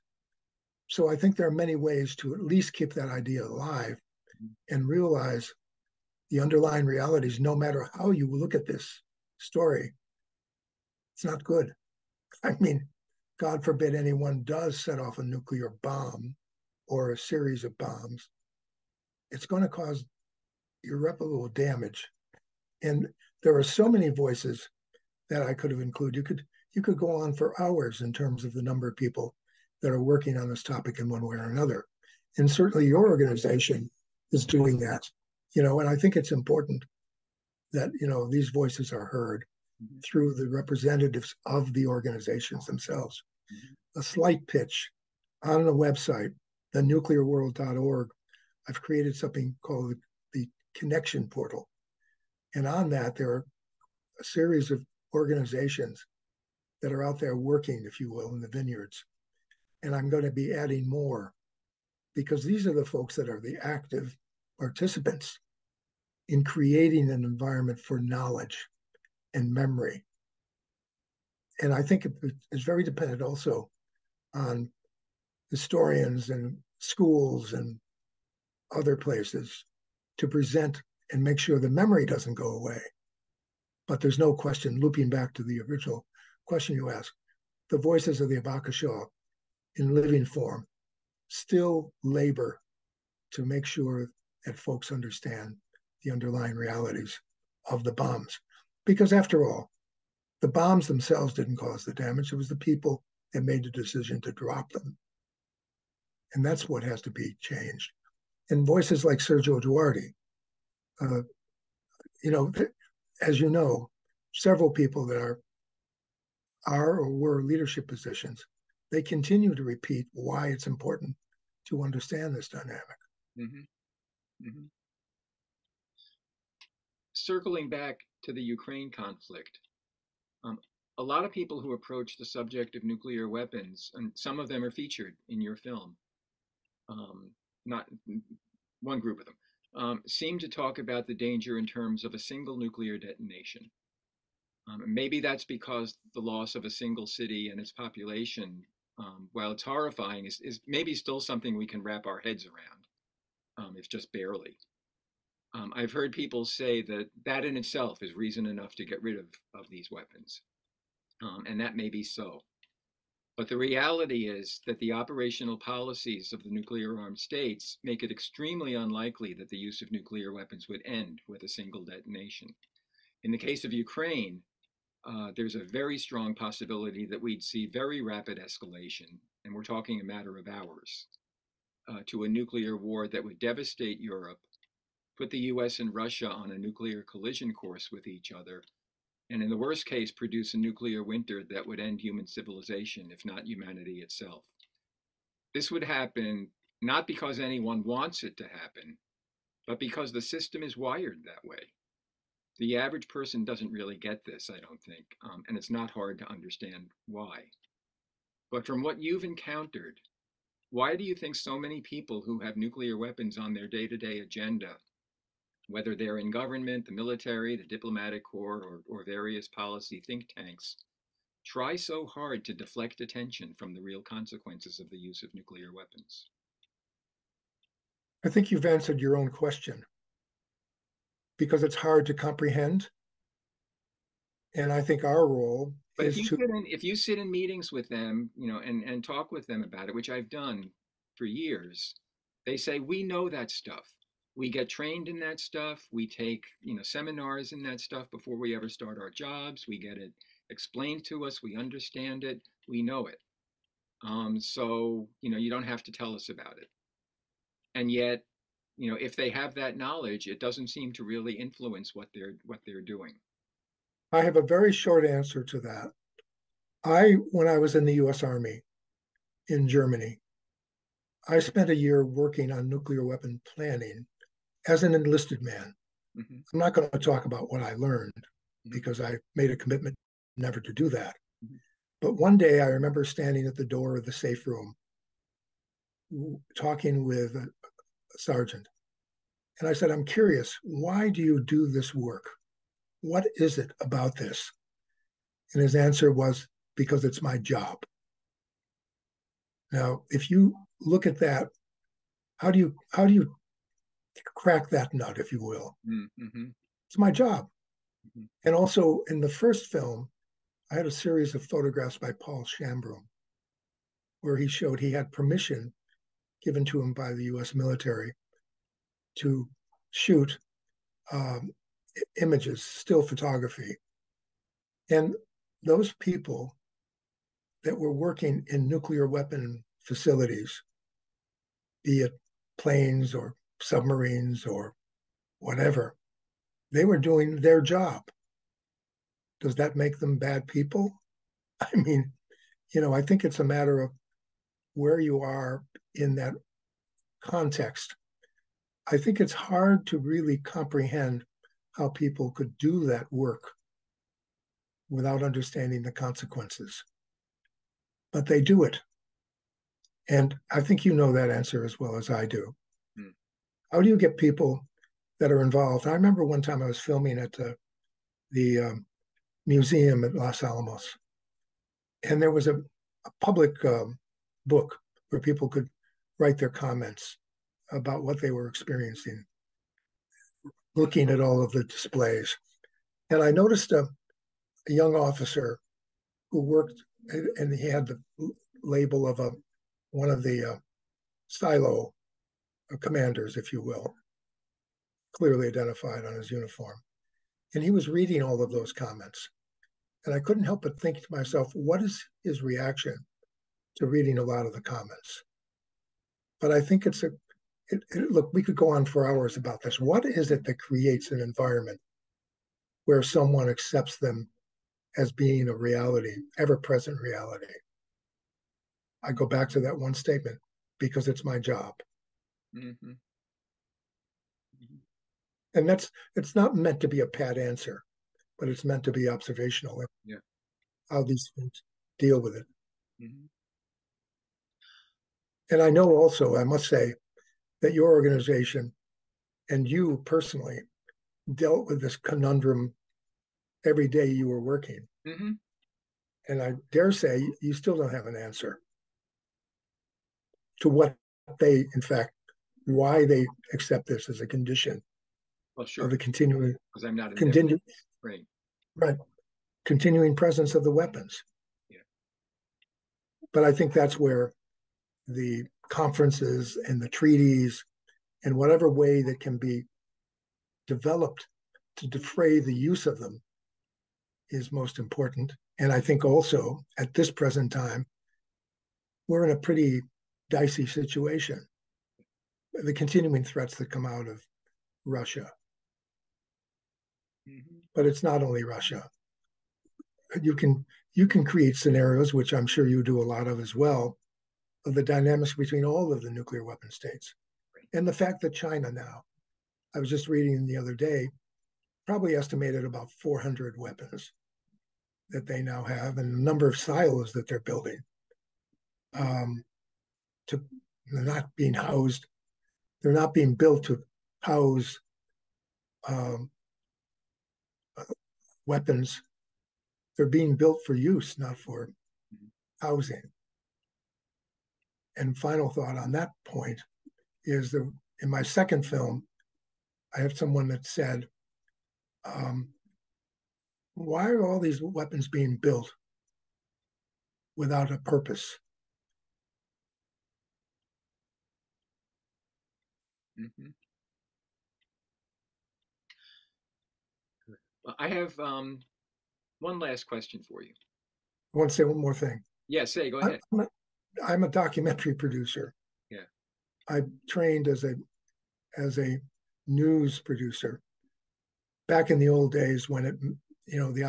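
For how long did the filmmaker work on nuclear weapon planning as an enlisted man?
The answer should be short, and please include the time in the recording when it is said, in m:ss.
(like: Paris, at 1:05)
a year, at 4:31.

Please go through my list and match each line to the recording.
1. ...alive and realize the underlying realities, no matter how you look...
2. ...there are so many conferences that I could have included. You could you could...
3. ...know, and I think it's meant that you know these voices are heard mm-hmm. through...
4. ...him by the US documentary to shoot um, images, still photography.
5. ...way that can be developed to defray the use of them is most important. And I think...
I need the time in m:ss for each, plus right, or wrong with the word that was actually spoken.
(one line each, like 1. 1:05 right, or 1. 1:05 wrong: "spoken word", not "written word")
1. 0:03 right
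2. 0:23 wrong: "voices", not "conferences"
3. 0:35 wrong: "important", not "meant"
4. 5:16 wrong: "military", not "documentary"
5. 7:48 right.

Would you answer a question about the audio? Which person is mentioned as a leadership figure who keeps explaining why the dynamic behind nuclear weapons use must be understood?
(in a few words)
Sergio Duarte.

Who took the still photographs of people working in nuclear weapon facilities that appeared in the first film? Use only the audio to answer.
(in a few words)
Paul Shambroom.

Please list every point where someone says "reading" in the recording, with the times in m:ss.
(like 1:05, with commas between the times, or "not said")
6:37, 6:43, 8:20.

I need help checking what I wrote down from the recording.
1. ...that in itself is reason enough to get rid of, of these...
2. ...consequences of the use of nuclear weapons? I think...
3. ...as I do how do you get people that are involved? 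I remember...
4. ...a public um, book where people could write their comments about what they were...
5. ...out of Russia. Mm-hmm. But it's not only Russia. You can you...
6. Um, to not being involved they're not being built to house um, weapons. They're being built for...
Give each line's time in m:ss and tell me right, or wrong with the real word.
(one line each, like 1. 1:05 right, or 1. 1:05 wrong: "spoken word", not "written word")
1. 2:37 right
2. 3:44 right
3. 6:01 right
4. 6:12 right
5. 8:03 right
6. 8:28 wrong: "housed", not "involved".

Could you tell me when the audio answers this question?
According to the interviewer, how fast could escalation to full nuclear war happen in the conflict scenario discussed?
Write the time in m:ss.
3:00.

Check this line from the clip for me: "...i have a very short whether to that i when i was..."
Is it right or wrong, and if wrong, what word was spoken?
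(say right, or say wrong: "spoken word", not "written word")
wrong: "answer", not "whether".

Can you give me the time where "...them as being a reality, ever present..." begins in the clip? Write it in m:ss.
6:53.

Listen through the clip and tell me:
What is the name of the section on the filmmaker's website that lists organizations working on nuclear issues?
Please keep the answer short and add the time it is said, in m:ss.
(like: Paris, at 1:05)
Connection Portal, at 0:50.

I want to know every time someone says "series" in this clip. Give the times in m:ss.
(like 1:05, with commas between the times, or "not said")
0:17, 0:54, 5:10.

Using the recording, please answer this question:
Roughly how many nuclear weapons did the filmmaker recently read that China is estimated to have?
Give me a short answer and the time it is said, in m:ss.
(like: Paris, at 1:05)
400, at 8:23.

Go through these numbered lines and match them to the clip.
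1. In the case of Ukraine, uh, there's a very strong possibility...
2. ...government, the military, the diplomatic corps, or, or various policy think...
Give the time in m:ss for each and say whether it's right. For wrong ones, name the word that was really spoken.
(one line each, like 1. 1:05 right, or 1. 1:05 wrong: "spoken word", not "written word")
1. 2:53 right
2. 3:36 right.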